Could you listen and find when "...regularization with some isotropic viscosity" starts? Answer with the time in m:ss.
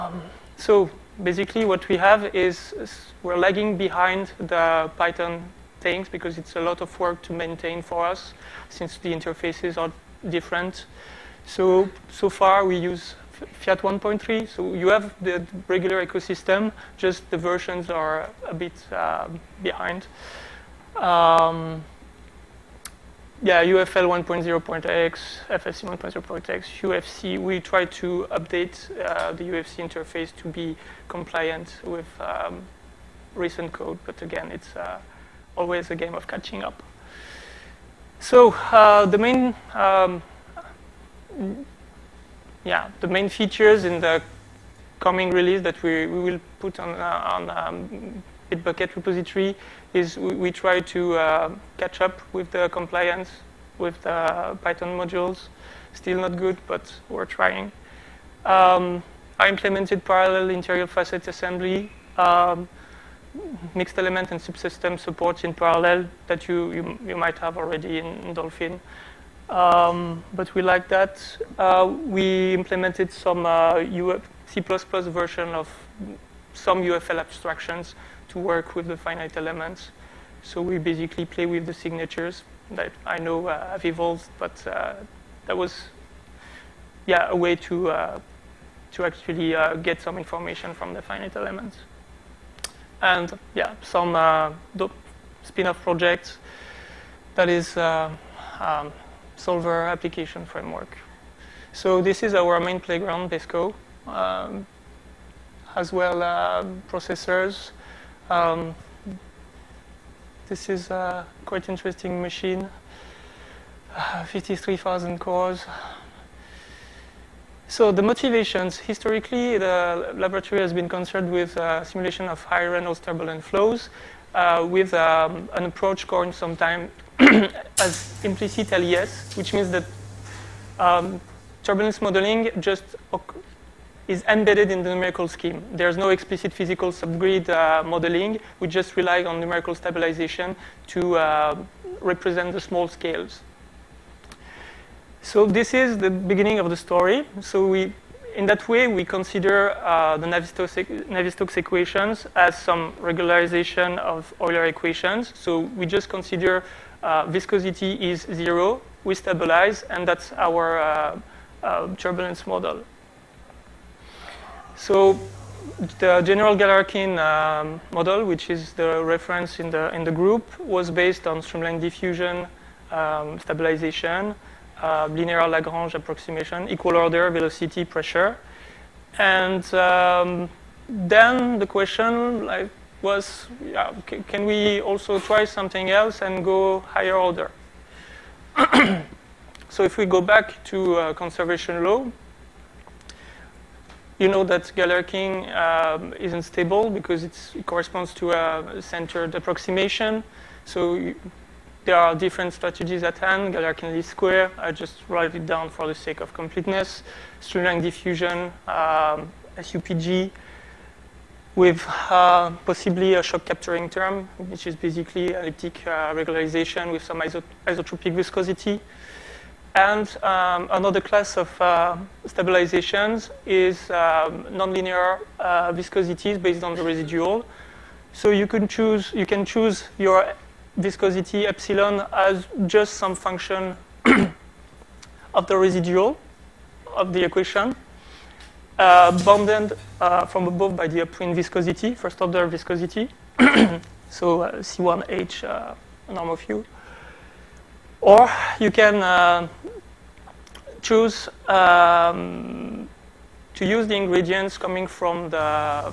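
3:36.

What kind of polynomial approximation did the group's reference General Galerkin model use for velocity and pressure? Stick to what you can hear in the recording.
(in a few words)
Linear Lagrange.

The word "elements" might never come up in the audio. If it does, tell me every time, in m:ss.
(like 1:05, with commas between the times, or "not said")
1:03, 1:19, 1:31.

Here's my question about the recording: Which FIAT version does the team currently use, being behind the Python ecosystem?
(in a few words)
1.3.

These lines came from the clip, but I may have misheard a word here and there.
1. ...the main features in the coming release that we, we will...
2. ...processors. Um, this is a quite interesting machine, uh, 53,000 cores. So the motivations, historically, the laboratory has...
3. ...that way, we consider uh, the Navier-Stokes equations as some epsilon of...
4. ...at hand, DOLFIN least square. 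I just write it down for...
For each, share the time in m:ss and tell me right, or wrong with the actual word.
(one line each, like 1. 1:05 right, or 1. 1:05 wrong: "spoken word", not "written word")
1. 0:43 right
2. 1:46 right
3. 2:28 wrong: "regularization", not "epsilon"
4. 3:23 wrong: "Galerkin", not "DOLFIN".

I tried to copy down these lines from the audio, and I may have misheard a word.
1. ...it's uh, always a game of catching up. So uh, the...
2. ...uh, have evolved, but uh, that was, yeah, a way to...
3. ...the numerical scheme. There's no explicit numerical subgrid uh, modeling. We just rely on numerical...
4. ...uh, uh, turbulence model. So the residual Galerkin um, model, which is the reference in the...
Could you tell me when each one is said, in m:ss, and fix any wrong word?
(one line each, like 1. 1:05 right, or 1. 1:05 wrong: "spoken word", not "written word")
1. 0:34 right
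2. 1:23 right
3. 2:14 wrong: "physical", not "numerical"
4. 2:40 wrong: "general", not "residual".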